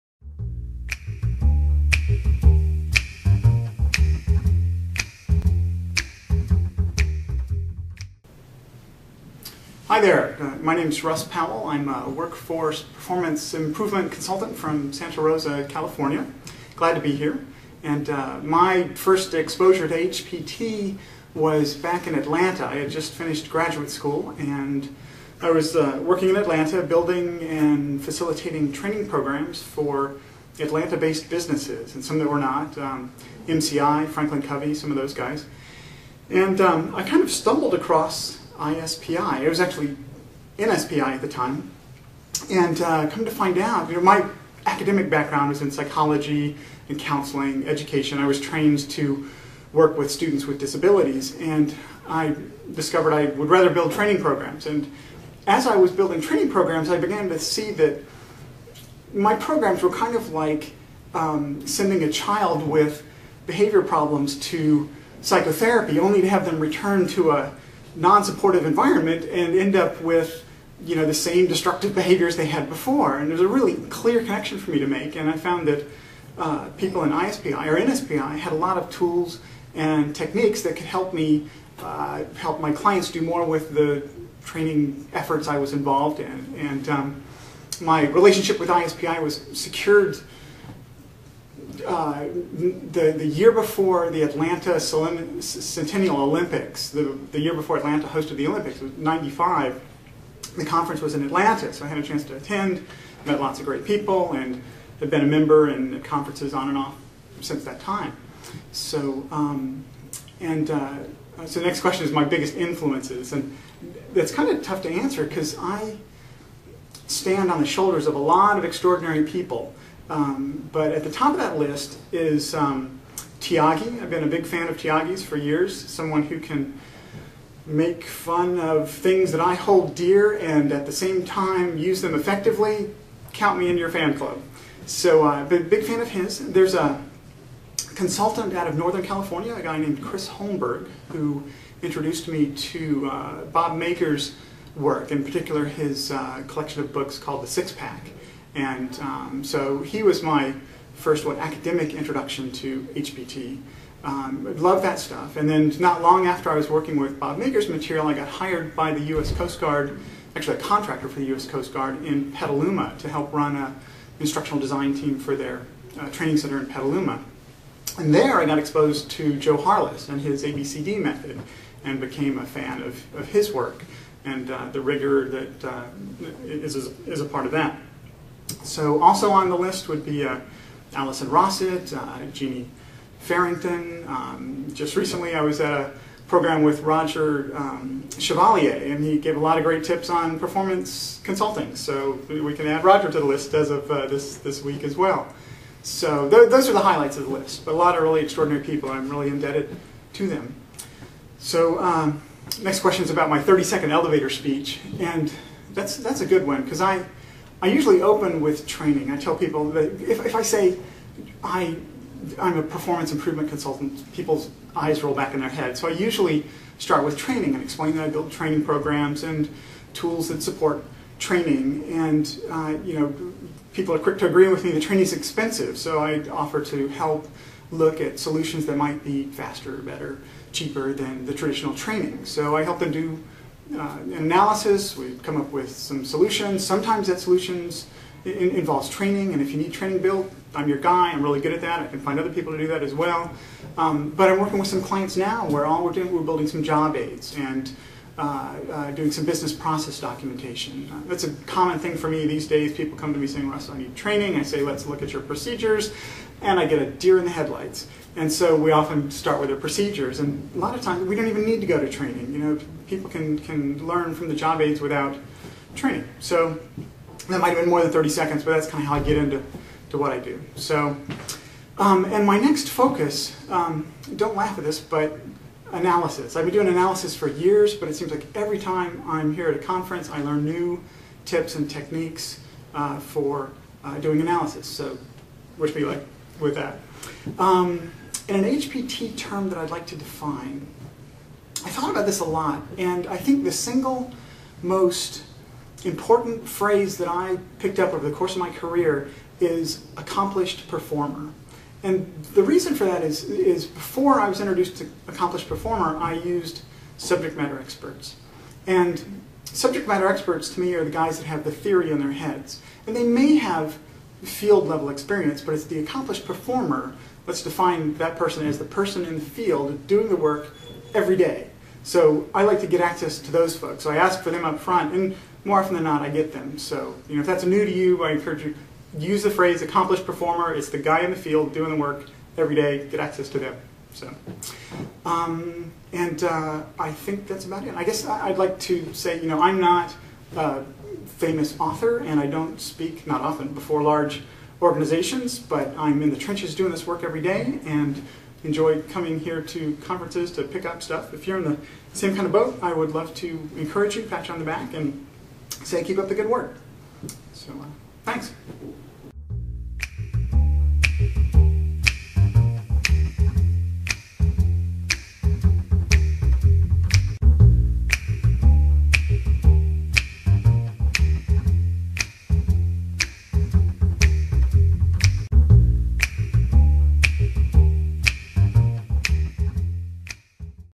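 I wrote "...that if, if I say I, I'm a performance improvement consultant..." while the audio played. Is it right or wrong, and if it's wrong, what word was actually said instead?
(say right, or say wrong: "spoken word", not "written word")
right.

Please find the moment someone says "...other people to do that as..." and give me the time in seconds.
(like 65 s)
242 s.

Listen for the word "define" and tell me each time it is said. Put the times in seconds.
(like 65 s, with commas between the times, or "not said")
289 s, 317 s.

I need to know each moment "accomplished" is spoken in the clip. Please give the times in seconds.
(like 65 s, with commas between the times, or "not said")
299 s, 305 s, 315 s, 329 s.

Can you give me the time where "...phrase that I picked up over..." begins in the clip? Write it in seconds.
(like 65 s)
296 s.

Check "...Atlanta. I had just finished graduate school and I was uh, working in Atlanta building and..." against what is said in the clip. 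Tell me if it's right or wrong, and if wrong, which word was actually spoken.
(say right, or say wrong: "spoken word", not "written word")
right.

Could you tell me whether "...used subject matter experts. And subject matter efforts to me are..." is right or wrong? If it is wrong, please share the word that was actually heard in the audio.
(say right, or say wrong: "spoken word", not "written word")
wrong: "experts", not "efforts".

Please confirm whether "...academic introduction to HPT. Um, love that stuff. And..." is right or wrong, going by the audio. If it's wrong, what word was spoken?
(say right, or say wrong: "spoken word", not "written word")
right.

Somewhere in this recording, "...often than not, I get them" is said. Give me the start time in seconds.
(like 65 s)
325 s.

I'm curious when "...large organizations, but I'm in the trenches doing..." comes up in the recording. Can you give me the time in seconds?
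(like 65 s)
343 s.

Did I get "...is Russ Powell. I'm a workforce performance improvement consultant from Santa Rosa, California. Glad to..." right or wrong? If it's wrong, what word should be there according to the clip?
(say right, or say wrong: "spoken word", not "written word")
right.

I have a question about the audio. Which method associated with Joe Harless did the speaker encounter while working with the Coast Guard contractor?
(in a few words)
ABCD method.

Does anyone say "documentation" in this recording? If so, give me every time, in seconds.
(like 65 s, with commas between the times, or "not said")
249 s.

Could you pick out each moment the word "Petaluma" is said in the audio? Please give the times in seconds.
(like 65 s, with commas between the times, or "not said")
162 s, 166 s.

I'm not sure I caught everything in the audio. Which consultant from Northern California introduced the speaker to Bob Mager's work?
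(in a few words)
Chris Holmberg.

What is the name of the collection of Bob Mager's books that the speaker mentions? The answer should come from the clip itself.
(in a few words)
The Six Pack.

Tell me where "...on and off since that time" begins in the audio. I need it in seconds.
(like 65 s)
106 s.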